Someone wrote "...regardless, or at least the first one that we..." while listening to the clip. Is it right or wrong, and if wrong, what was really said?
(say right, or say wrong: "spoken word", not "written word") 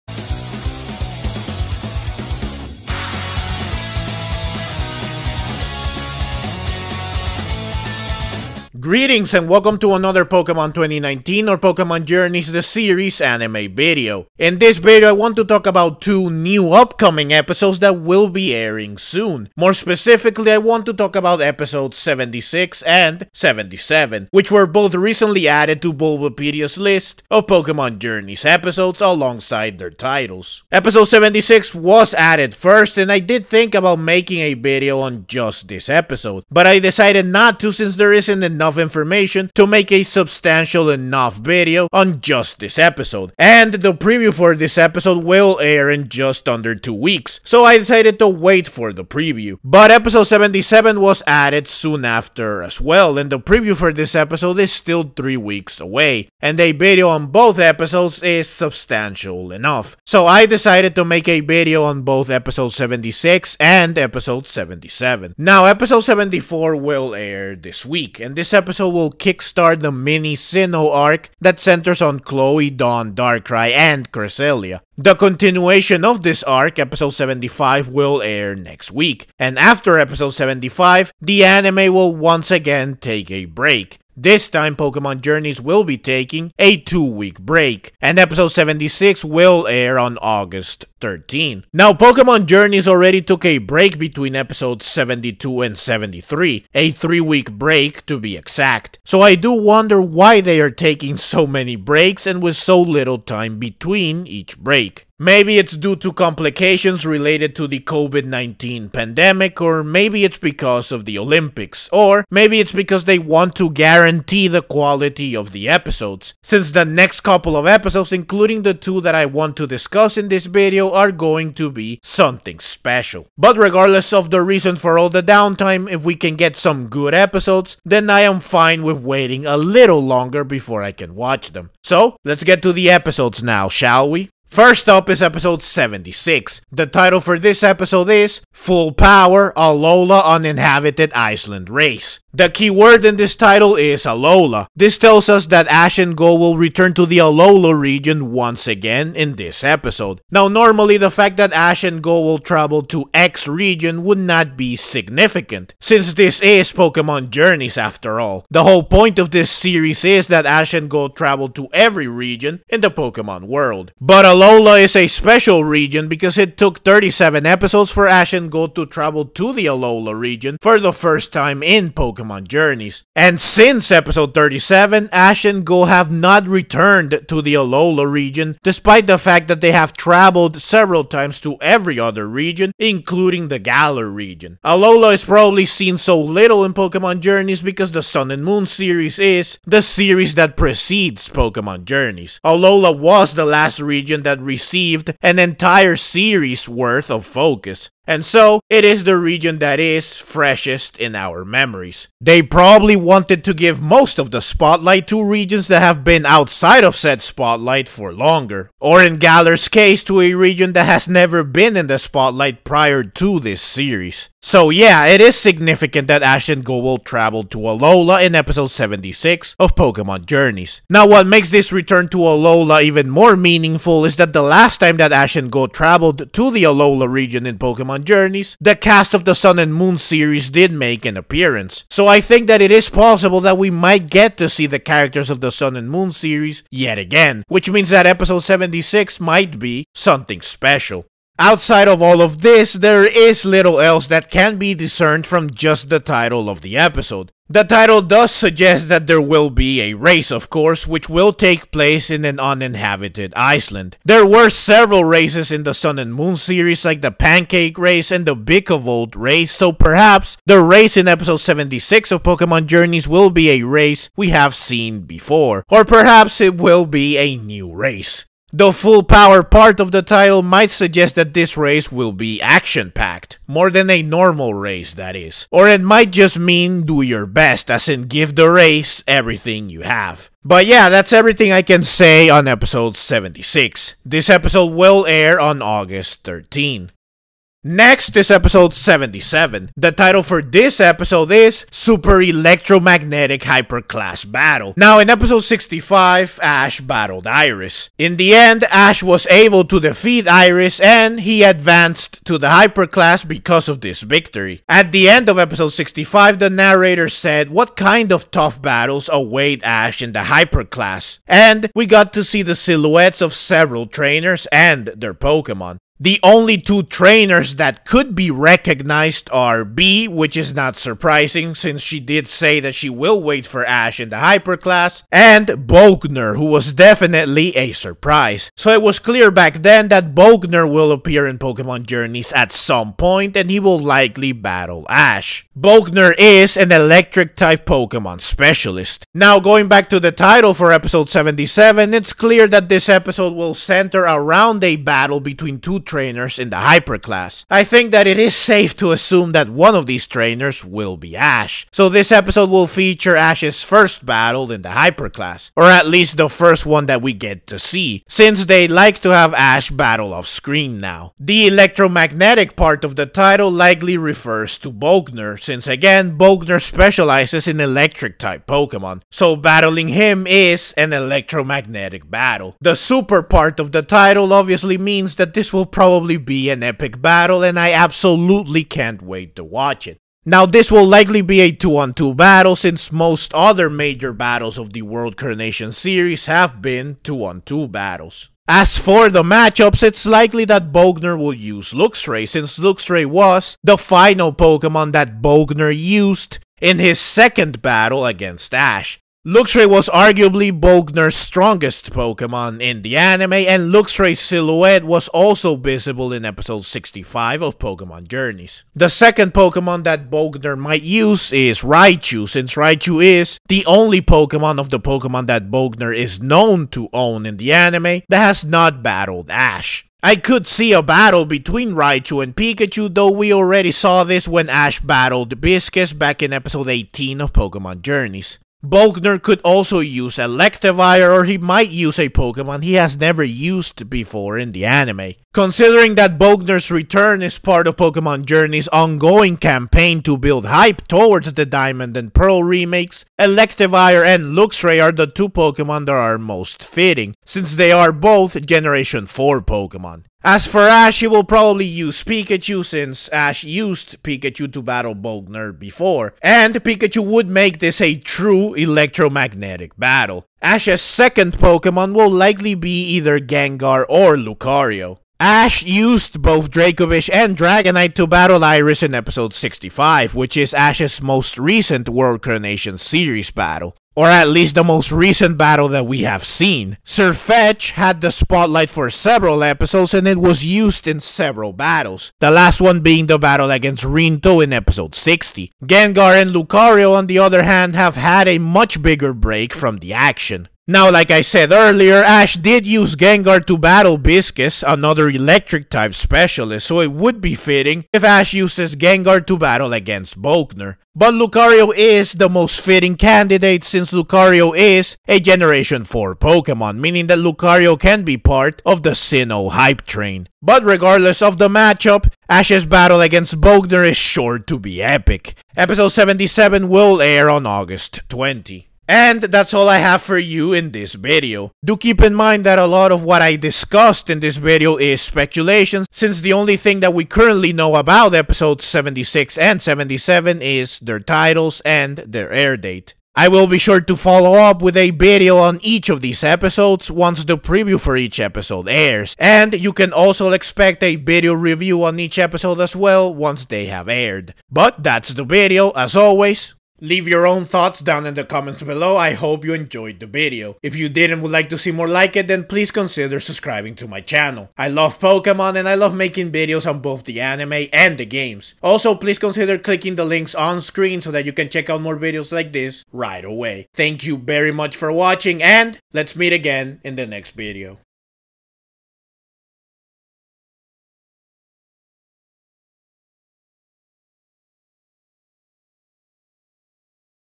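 wrong: "class", not "regardless".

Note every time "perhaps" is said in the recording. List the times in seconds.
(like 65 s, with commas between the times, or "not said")
259 s, 265 s.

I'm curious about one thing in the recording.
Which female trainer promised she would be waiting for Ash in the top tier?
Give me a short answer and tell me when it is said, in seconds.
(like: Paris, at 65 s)
Bea, at 319 s.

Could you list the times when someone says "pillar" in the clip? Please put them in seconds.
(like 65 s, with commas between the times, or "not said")
not said.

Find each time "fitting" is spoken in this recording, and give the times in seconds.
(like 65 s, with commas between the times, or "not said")
446 s, 497 s, 502 s.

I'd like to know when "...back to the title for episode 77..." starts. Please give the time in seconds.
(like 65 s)
339 s.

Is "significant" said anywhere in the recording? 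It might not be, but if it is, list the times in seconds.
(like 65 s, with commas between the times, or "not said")
154 s, 215 s.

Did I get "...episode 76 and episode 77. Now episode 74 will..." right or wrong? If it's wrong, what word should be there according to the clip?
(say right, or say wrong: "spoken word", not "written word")
right.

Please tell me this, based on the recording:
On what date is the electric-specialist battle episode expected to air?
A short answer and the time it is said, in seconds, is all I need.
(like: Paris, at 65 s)
August 20, at 517 s.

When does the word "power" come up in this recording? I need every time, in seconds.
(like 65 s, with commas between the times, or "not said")
138 s, 269 s.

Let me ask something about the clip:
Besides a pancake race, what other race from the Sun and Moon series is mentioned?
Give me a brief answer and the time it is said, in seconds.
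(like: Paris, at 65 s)
Bicavolt race, at 258 s.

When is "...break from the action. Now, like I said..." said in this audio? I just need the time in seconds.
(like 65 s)
489 s.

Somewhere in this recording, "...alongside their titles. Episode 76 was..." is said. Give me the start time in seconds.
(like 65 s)
28 s.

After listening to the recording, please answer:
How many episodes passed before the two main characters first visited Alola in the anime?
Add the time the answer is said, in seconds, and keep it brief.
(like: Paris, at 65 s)
37, at 166 s.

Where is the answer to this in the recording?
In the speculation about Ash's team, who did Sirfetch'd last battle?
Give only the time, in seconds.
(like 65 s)
483 s.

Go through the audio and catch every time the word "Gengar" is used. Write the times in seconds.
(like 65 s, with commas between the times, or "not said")
463 s, 485 s, 492 s, 498 s.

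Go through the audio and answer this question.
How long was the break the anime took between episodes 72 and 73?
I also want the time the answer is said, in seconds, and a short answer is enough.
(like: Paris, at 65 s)
3 weeks, at 96 s.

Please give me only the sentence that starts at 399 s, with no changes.
Luxray was arguably Volkner's strongest Pokemon in the anime, and Luxray's silhouette was also visible in episode 65 of Pokemon Journeys.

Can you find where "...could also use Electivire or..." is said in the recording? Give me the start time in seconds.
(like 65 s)
429 s.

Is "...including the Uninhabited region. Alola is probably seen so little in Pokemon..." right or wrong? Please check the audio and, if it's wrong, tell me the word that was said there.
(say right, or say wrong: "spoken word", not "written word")
wrong: "Galar", not "Uninhabited".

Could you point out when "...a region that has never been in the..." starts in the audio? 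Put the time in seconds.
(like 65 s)
210 s.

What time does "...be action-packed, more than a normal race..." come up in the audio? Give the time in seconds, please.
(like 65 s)
272 s.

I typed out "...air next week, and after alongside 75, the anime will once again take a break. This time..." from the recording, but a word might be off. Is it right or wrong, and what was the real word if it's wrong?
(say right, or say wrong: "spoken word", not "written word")
wrong: "episode", not "alongside".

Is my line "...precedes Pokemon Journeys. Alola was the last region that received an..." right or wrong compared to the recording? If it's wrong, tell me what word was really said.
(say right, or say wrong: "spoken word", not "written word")
right.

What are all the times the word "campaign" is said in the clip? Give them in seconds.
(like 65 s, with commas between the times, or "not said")
439 s.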